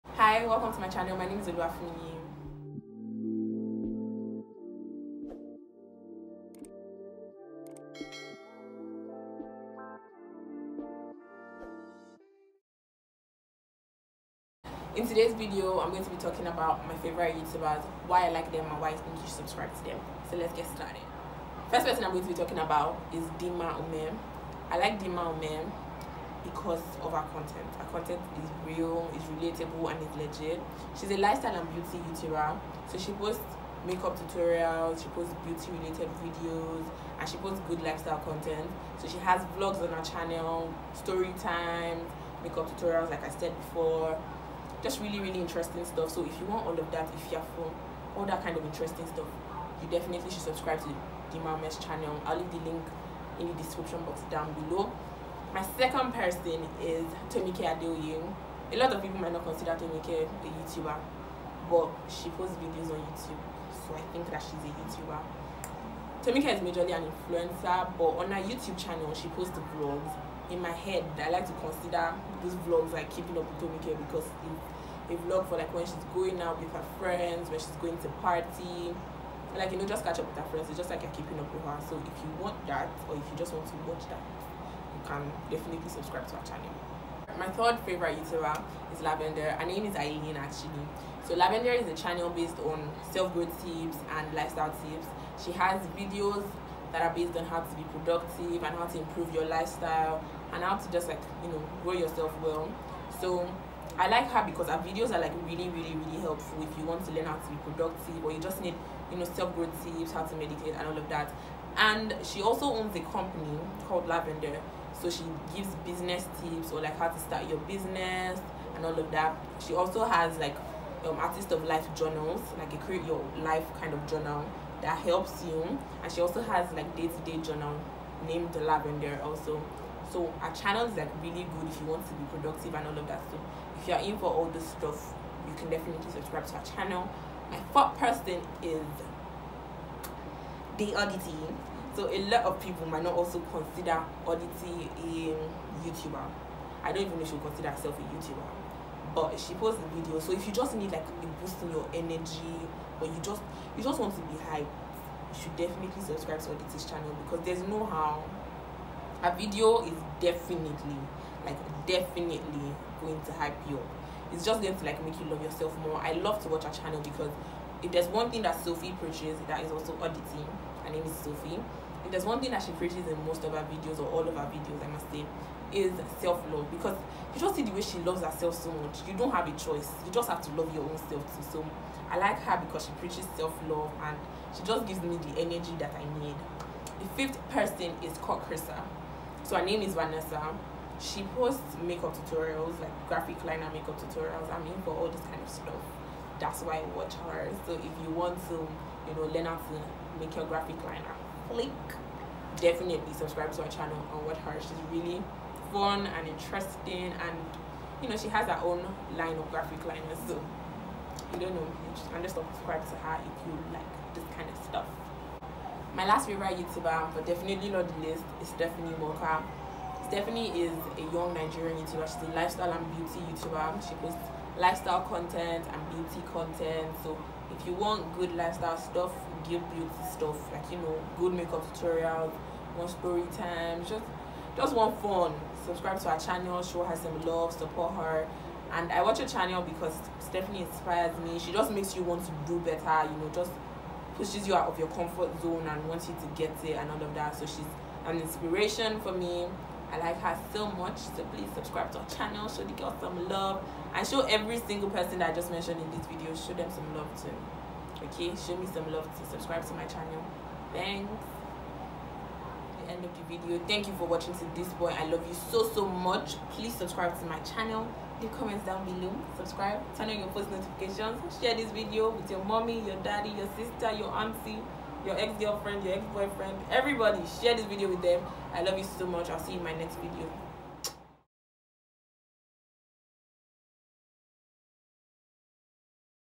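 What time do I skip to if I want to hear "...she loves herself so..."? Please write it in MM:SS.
02:57.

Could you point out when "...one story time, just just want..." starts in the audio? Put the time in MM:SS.
03:52.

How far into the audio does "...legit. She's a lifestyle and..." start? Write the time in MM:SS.
00:30.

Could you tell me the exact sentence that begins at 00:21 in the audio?
First person I'm going to be talking about is Dimma Umeh.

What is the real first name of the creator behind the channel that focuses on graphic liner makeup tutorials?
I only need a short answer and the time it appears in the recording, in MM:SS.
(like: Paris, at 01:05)
Vanessa, at 03:09.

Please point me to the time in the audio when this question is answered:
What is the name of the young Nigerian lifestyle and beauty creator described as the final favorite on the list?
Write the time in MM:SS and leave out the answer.
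03:38.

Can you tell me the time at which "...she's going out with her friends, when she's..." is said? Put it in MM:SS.
01:15.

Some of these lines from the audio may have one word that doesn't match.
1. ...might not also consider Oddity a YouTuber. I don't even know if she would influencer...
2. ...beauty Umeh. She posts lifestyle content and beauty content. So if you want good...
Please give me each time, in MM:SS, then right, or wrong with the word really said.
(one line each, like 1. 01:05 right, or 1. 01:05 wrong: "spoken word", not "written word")
1. 02:22 wrong: "consider", not "influencer"
2. 03:42 wrong: "YouTuber", not "Umeh".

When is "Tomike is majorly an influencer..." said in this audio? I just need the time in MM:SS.
01:06.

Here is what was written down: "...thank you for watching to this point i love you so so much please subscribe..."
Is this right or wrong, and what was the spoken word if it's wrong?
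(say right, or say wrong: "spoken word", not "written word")
right.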